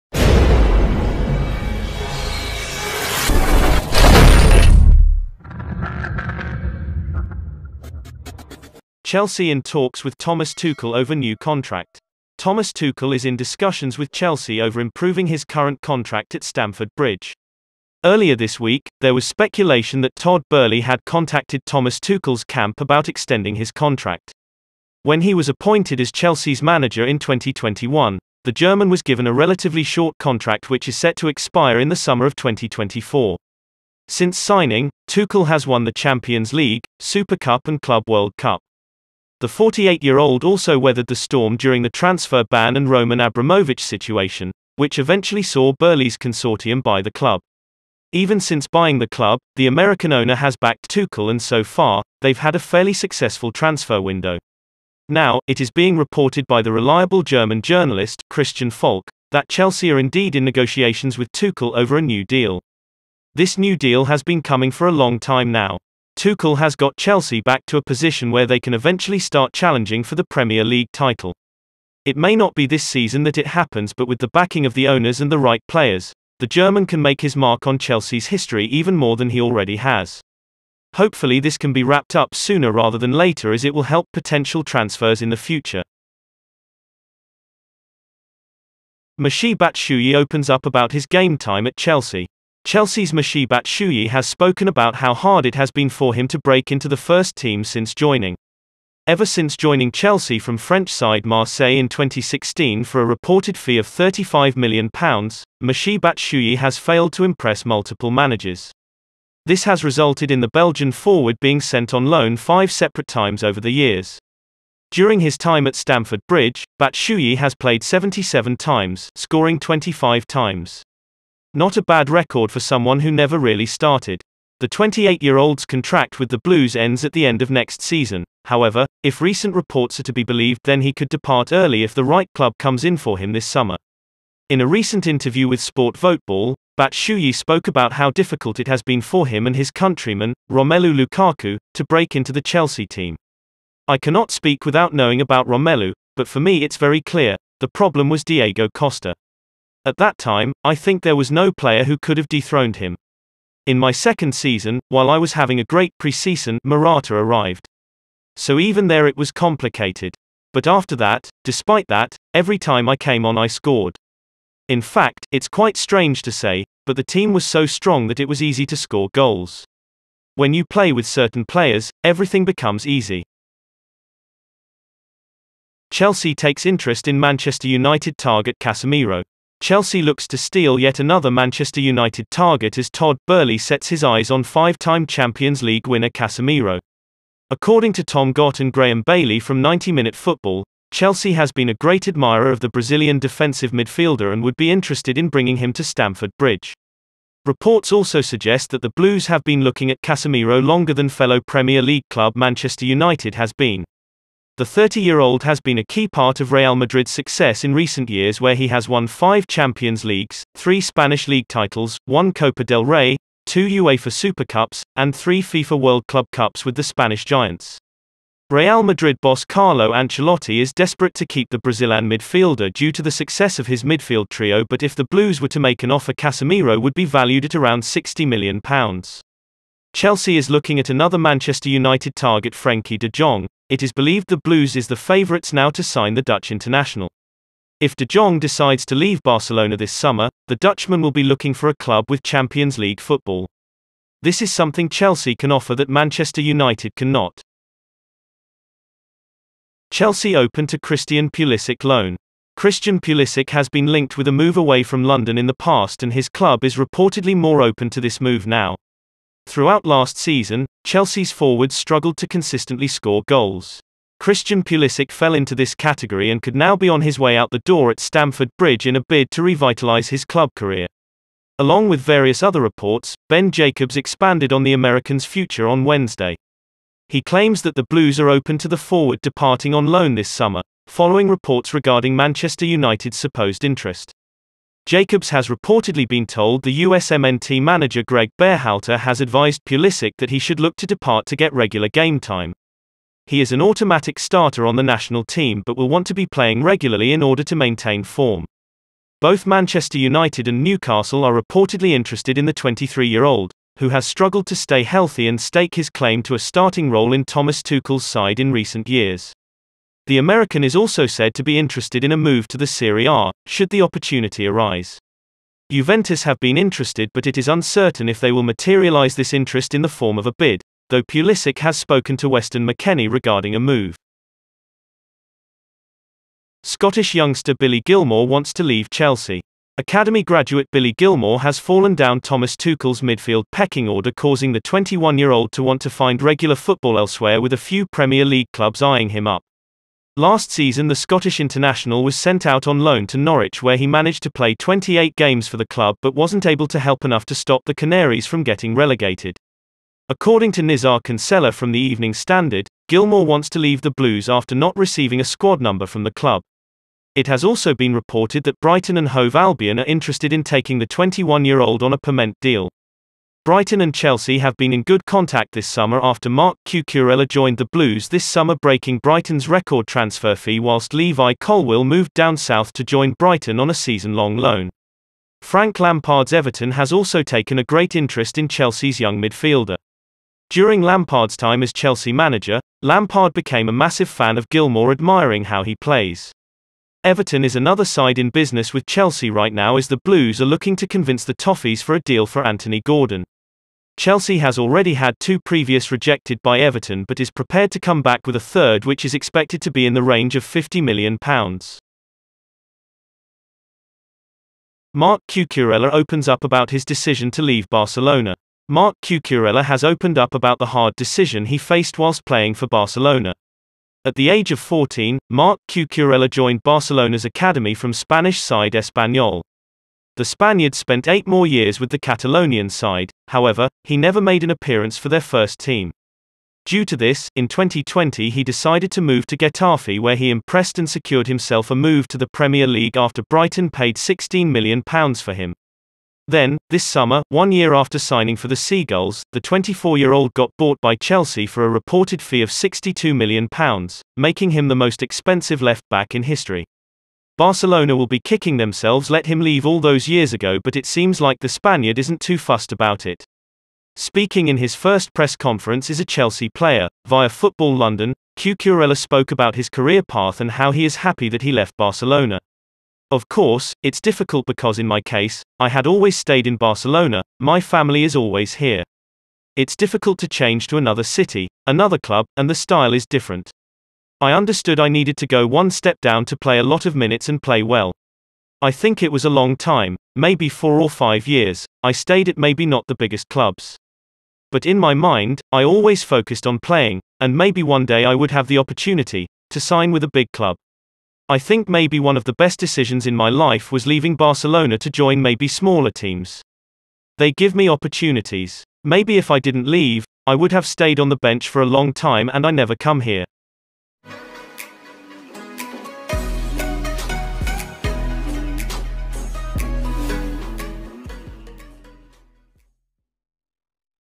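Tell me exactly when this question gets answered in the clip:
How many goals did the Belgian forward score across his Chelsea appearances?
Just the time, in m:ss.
1:59.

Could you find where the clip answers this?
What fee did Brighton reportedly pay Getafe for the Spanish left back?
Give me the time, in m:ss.
7:13.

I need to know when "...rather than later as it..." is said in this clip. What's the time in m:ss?
1:22.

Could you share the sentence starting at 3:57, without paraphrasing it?
If de Jong decides to leave Barcelona this summer, the Dutchman will be looking for a club with Champions League football.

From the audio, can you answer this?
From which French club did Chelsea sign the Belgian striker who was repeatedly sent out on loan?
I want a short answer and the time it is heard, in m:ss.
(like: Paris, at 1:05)
Marseille, at 1:41.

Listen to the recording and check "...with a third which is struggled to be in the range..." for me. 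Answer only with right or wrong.
wrong.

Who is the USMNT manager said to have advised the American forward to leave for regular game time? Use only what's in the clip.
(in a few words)
Gregg Berhalter.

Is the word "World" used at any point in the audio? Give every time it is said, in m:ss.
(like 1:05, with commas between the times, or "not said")
0:38, 3:35.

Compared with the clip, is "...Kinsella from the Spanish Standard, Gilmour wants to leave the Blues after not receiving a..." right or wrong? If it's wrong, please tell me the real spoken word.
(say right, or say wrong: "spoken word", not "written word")
wrong: "Evening", not "Spanish".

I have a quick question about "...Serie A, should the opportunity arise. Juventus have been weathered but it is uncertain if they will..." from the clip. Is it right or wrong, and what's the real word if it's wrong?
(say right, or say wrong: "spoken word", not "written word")
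wrong: "interested", not "weathered".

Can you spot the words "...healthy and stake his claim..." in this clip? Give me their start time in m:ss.
5:04.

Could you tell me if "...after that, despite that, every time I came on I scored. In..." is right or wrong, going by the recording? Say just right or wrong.
right.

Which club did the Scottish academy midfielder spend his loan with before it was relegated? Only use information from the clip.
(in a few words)
Norwich.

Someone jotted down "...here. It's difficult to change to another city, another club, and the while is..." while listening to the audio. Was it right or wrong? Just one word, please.
wrong.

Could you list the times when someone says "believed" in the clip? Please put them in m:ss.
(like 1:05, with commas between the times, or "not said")
2:10, 3:53.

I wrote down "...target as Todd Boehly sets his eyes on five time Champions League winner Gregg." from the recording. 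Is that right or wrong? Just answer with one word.
wrong.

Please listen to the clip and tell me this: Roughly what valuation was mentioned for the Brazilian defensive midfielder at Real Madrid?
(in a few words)
£60 million.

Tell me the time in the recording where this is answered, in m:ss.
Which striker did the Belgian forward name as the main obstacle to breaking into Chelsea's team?
2:28.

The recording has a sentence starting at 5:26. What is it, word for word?
Scottish youngster Billy Gilmour wants to leave Chelsea.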